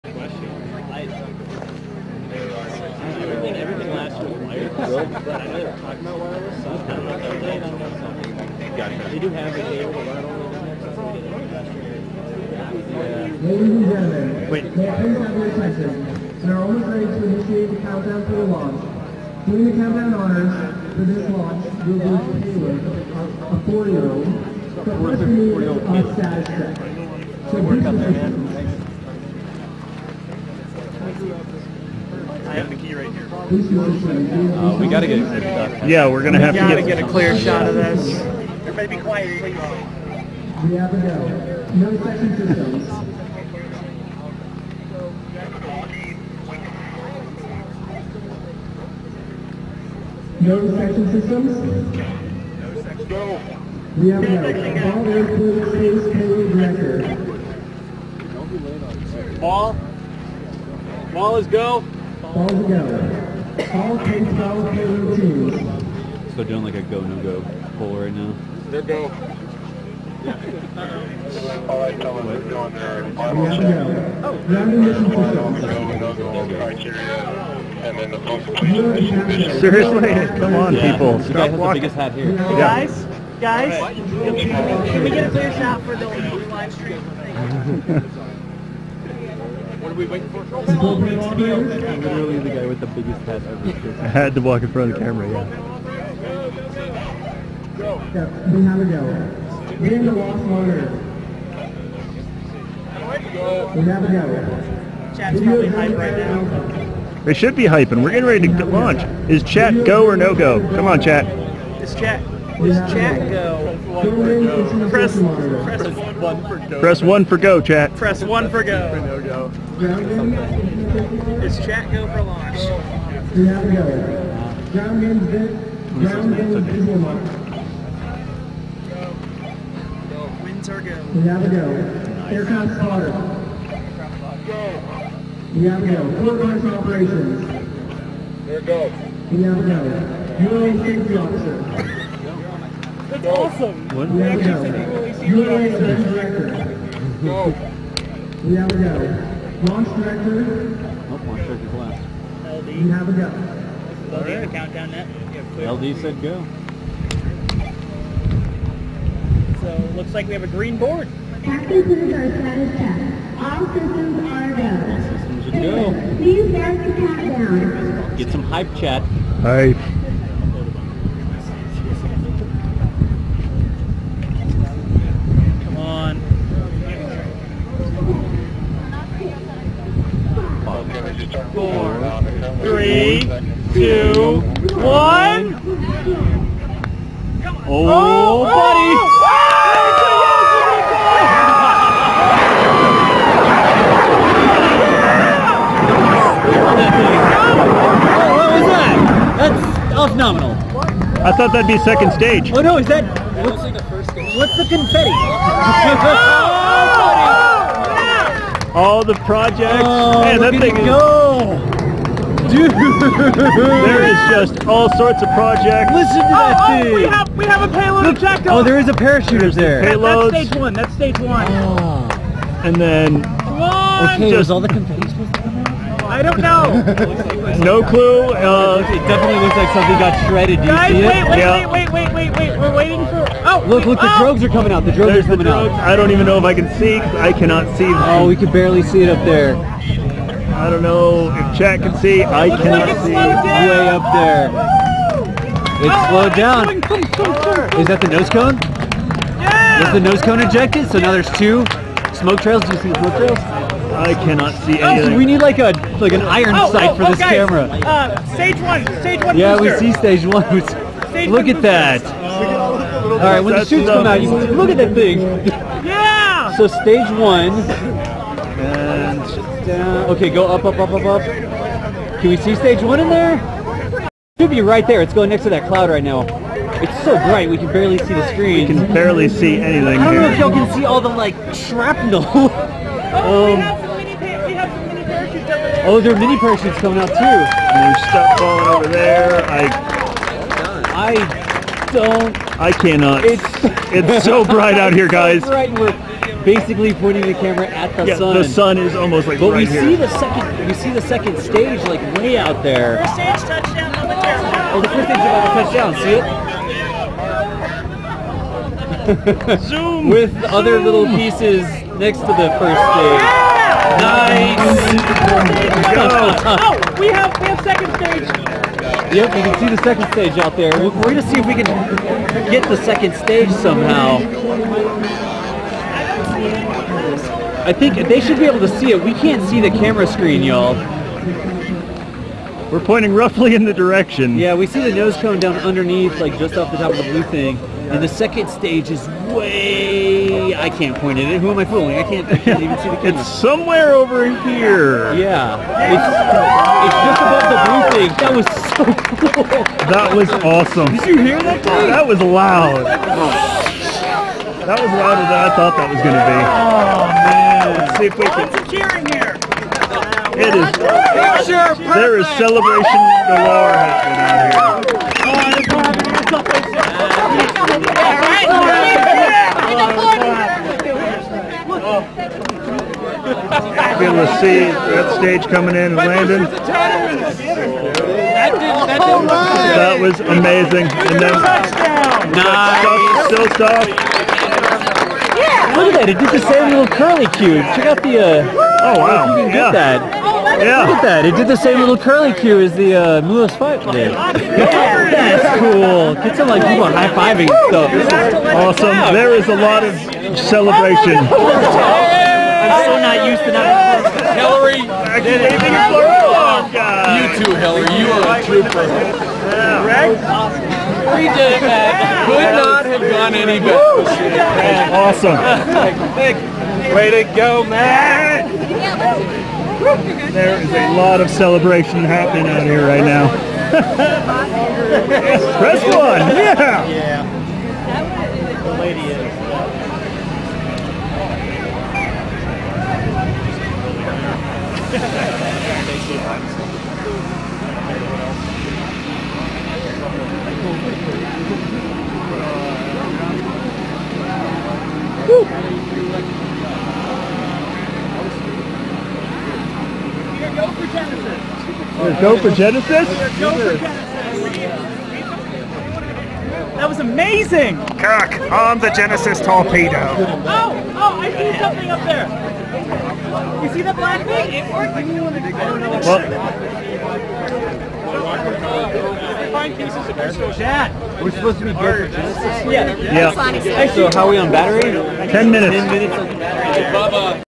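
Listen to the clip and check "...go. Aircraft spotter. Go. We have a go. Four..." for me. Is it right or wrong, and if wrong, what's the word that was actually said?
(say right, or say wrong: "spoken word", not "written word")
right.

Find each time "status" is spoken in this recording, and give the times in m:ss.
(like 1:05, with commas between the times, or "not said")
0:26, 2:42.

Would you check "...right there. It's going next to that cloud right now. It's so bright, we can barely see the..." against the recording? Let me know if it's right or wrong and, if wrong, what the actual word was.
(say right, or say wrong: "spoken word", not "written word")
right.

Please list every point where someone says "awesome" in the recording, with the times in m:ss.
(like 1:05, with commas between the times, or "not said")
2:23, 5:50, 6:38, 6:54.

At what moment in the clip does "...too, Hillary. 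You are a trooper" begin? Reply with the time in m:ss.
6:47.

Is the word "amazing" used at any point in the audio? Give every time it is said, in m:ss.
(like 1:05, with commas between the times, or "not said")
6:20, 7:36.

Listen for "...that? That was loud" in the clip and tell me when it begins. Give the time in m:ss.
5:51.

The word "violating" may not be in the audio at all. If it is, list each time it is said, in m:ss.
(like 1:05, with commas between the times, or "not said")
not said.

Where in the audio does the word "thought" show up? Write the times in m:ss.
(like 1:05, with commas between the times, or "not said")
3:21, 5:55.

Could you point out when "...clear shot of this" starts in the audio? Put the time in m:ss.
0:37.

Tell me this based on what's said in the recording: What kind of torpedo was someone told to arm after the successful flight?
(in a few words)
Genesis torpedo.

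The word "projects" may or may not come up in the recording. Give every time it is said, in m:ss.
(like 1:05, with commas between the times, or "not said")
3:29, 3:35.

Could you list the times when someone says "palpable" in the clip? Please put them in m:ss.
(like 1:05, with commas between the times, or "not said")
not said.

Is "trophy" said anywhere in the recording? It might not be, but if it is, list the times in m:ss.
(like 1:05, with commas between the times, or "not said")
not said.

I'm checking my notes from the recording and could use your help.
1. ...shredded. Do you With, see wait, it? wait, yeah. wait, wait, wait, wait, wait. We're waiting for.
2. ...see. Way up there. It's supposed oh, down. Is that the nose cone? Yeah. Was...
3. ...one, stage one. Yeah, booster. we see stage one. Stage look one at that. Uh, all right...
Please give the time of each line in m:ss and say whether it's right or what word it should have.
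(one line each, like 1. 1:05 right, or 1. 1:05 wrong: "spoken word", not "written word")
1. 3:50 wrong: "Guys", not "With"
2. 4:03 wrong: "slowed", not "supposed"
3. 4:18 right.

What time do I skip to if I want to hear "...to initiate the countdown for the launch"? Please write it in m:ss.
0:17.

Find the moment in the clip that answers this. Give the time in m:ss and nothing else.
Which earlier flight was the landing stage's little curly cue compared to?
6:33.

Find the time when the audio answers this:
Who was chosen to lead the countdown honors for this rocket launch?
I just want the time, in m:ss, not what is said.
0:22.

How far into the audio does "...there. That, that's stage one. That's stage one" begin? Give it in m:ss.
3:39.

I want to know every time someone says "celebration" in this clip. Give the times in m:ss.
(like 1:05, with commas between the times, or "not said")
6:02, 6:40, 7:01.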